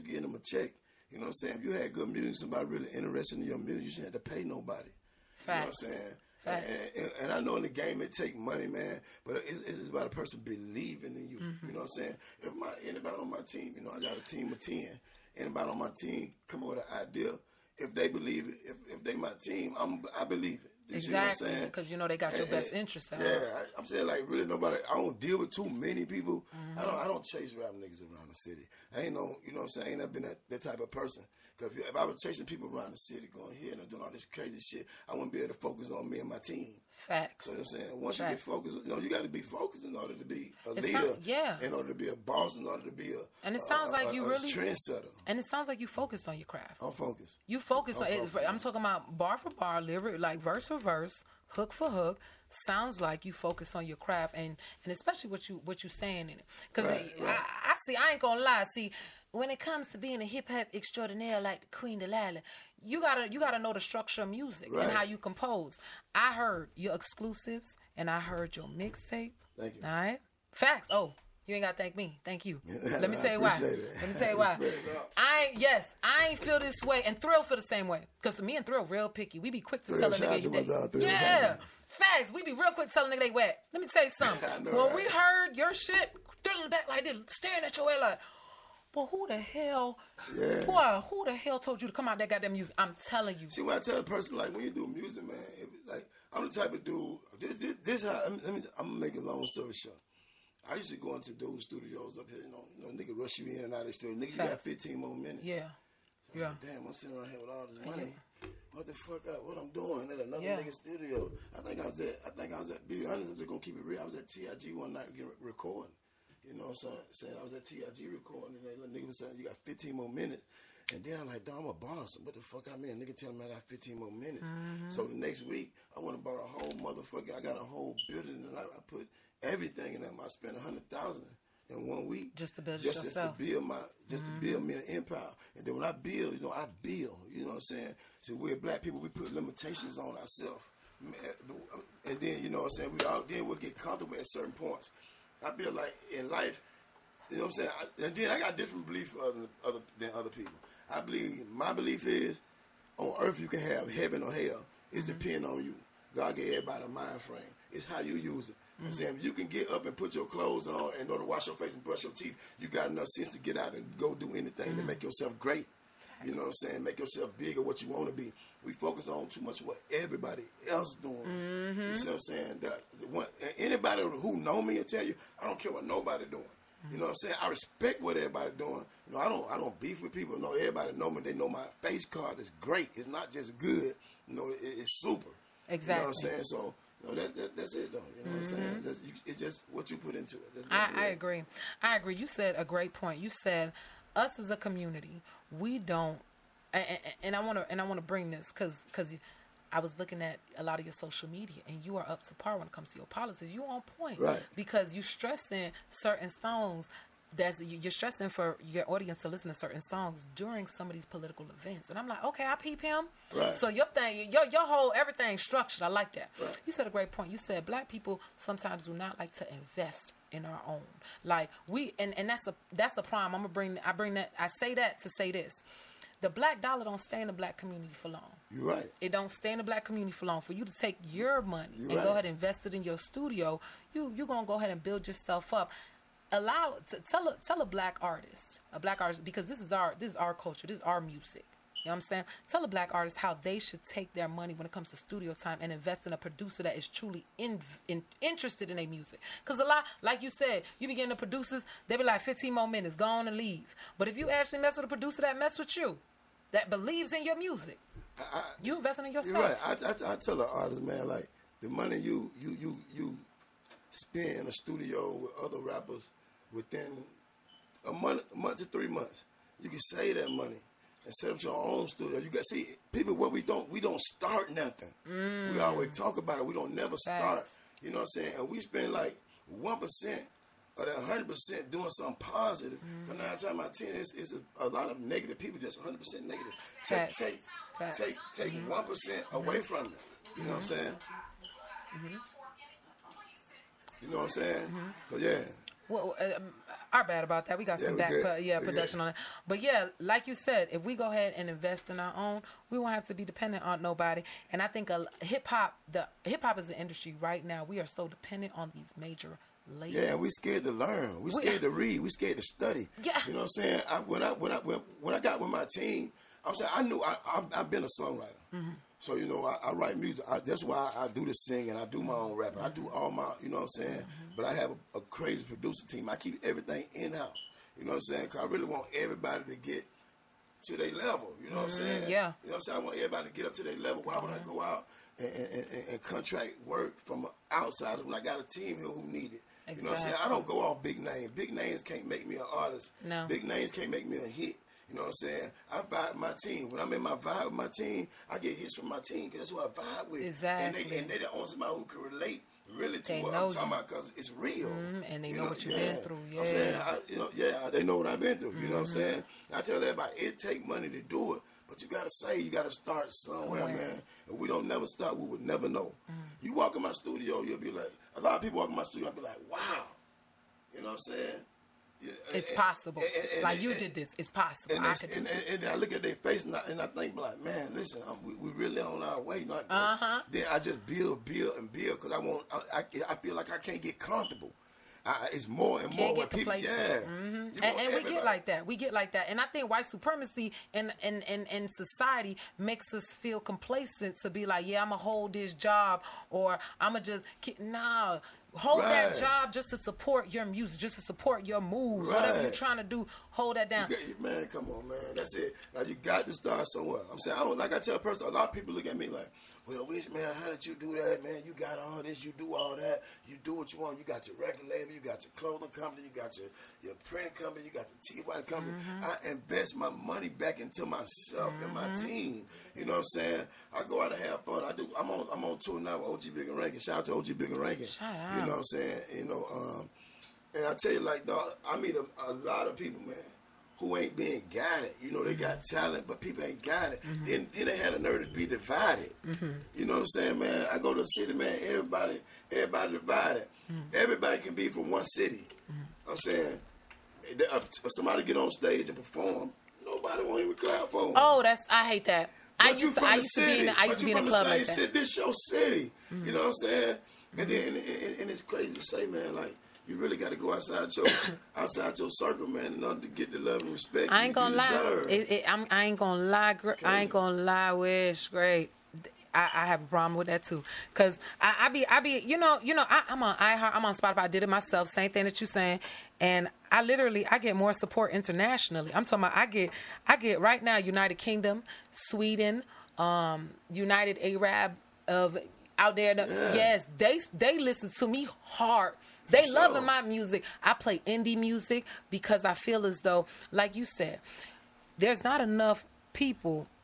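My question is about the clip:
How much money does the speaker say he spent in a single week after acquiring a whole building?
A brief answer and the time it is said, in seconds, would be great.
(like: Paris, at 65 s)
100,000, at 130 s.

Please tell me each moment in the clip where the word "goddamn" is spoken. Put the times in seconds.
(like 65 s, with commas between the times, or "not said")
92 s.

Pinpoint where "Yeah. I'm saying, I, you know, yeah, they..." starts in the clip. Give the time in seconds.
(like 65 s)
356 s.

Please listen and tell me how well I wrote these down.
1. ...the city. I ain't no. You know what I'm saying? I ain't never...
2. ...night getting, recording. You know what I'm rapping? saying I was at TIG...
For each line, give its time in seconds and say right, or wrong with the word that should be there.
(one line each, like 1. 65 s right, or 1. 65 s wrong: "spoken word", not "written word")
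1. 28 s right
2. 114 s wrong: "saying", not "rapping".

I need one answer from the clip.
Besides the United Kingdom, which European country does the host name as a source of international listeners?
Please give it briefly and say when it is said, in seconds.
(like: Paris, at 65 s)
Sweden, at 481 s.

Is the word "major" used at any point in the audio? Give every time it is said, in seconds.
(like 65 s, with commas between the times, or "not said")
308 s.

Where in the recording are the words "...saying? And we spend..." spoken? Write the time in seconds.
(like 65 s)
278 s.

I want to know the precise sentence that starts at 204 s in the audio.
Because you stressing certain songs that's you're stressing for your audience to listen to certain songs during some of these political events.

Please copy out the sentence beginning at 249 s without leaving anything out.
Because a lot, like you said, you begin the producers, they be like 15 more minutes, go on and leave.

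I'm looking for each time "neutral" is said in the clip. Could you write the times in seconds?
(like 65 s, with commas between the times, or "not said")
not said.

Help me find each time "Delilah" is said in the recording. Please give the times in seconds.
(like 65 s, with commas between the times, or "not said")
61 s.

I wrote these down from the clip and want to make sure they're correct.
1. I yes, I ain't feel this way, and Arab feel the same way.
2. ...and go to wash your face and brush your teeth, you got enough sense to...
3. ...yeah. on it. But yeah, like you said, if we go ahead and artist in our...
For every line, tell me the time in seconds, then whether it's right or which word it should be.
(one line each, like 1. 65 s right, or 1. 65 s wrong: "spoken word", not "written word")
1. 75 s wrong: "Thrill", not "Arab"
2. 160 s right
3. 298 s wrong: "invest", not "artist".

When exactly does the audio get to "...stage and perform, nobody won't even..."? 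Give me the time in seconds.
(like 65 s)
448 s.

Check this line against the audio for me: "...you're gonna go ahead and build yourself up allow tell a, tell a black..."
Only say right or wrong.
right.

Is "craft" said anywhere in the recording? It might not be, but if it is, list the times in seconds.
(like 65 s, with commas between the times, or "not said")
46 s, 53 s.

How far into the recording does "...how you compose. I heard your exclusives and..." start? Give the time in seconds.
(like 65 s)
64 s.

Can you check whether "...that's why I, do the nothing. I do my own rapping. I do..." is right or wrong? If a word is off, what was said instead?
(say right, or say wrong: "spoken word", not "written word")
wrong: "singing", not "nothing".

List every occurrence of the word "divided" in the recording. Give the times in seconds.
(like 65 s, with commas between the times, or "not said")
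438 s, 442 s.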